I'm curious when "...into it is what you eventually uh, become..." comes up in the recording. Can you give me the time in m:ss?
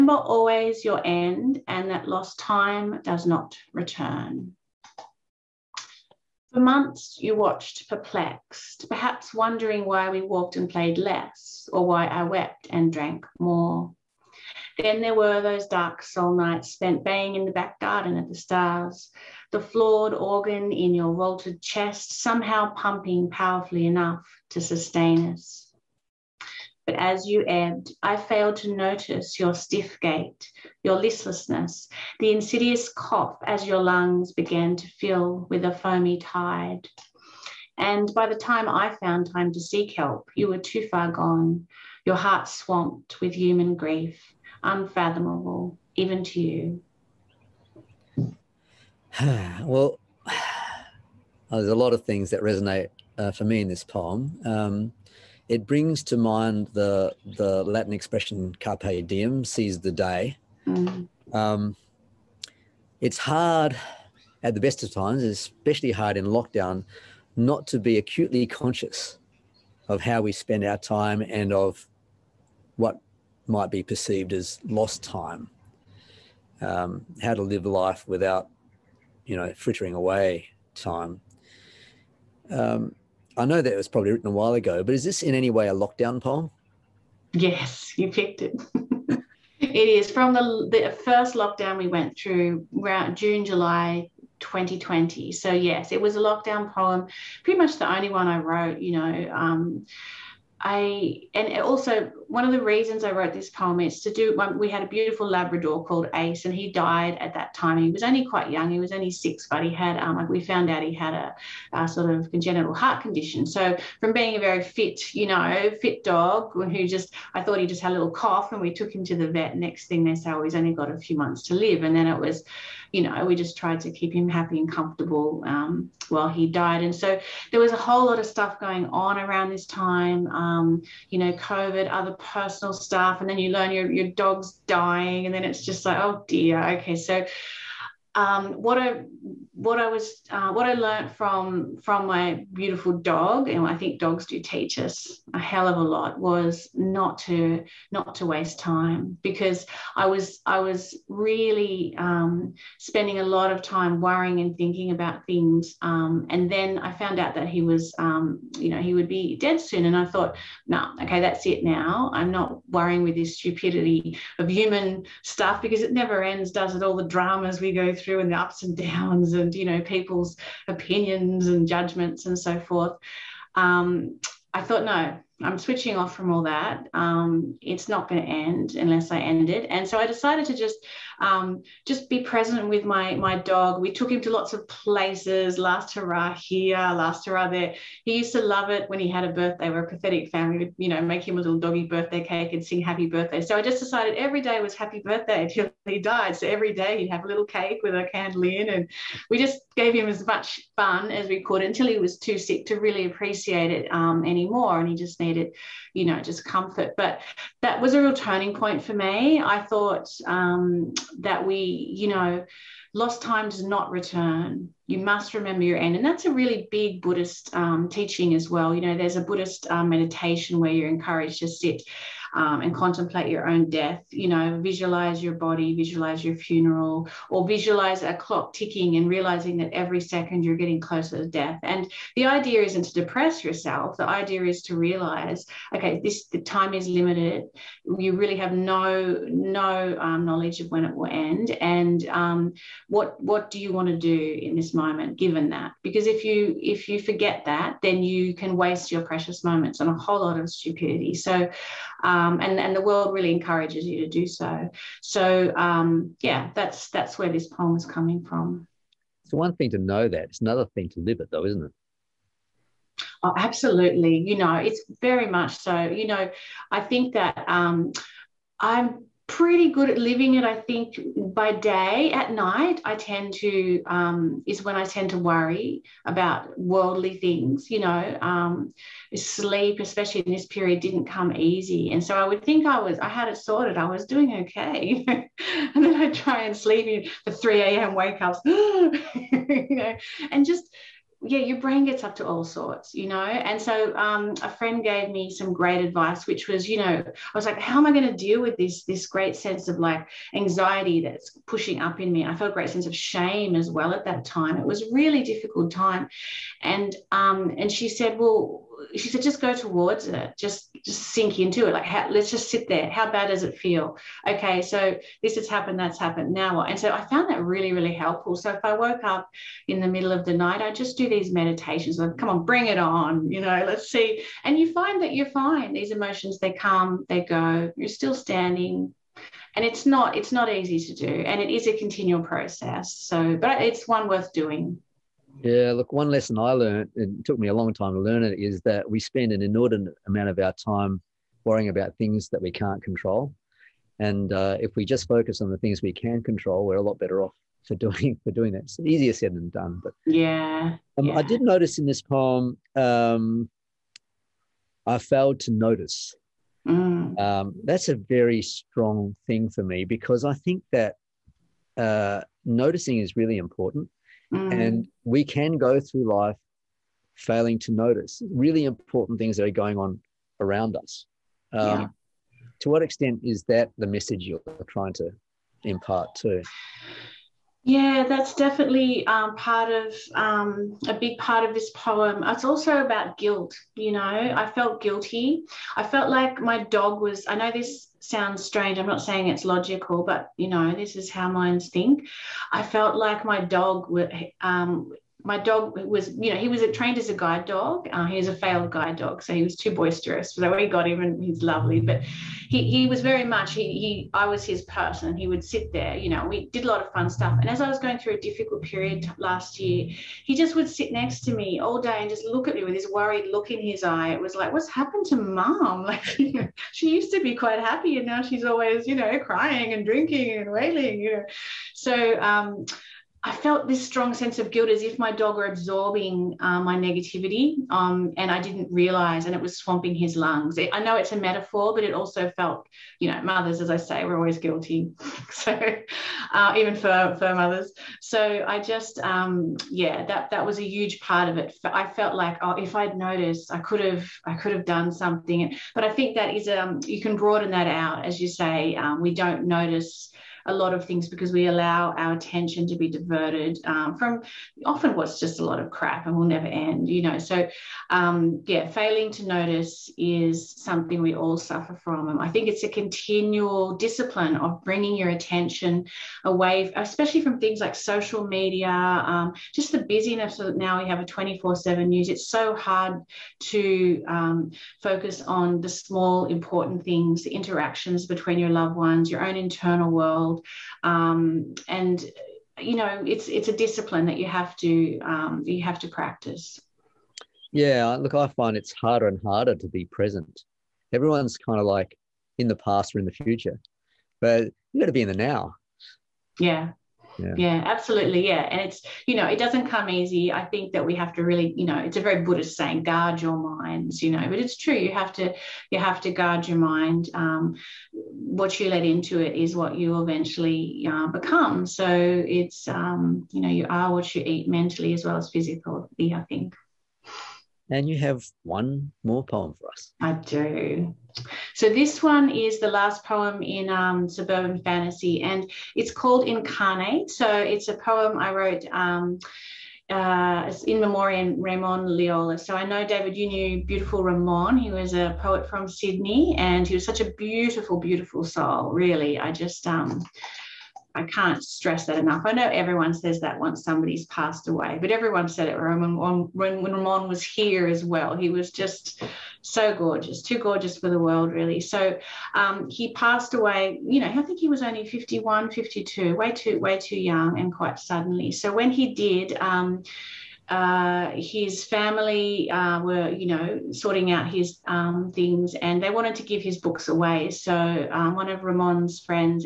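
8:28.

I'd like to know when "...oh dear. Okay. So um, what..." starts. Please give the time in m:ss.
2:15.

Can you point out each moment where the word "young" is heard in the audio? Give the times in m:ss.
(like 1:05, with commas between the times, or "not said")
1:48, 9:16.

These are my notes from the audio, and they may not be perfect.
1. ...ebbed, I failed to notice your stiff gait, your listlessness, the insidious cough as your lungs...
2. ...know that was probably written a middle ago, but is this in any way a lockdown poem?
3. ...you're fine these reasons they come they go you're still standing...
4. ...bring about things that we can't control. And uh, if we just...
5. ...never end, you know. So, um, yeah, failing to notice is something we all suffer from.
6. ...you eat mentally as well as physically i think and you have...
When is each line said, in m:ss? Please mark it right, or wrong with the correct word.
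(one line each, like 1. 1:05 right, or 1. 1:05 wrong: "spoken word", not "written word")
1. 0:27 right
2. 1:23 wrong: "while", not "middle"
3. 5:25 wrong: "emotions", not "reasons"
4. 5:41 wrong: "worrying", not "bring"
5. 7:36 right
6. 8:34 right.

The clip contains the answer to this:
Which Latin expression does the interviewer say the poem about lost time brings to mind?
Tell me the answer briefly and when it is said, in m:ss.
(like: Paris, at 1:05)
carpe diem, at 0:58.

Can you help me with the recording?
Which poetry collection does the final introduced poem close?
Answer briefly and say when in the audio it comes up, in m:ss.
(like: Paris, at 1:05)
Suburban Fantasy, at 8:44.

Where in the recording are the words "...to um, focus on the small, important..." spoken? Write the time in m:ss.
7:53.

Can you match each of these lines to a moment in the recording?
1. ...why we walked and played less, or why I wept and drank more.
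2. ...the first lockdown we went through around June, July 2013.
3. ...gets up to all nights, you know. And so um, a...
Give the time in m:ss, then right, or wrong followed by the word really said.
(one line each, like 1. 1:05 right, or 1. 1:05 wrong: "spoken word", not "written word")
1. 0:09 right
2. 1:30 wrong: "2020", not "2013"
3. 4:51 wrong: "sorts", not "nights".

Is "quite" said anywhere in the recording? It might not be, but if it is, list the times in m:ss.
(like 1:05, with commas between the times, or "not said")
1:48, 6:57, 9:17.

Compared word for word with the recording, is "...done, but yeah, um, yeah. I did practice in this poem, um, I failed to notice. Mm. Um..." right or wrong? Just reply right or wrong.
wrong.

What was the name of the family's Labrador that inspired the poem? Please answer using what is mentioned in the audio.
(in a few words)
Ace.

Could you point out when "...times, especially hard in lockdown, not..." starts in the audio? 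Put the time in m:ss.
1:04.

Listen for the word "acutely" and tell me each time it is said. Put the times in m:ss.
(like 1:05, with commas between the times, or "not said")
1:07.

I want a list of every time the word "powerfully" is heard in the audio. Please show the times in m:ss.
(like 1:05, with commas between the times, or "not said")
0:23.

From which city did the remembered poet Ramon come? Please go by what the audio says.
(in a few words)
Sydney.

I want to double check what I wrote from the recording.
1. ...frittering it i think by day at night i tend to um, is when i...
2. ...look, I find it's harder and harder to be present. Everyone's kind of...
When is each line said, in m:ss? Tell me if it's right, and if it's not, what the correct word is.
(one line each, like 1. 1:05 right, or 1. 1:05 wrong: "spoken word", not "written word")
1. 4:29 wrong: "living", not "frittering"
2. 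8:07 right.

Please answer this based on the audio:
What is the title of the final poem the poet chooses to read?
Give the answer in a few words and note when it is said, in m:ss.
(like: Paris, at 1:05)
Incarnate, at 8:46.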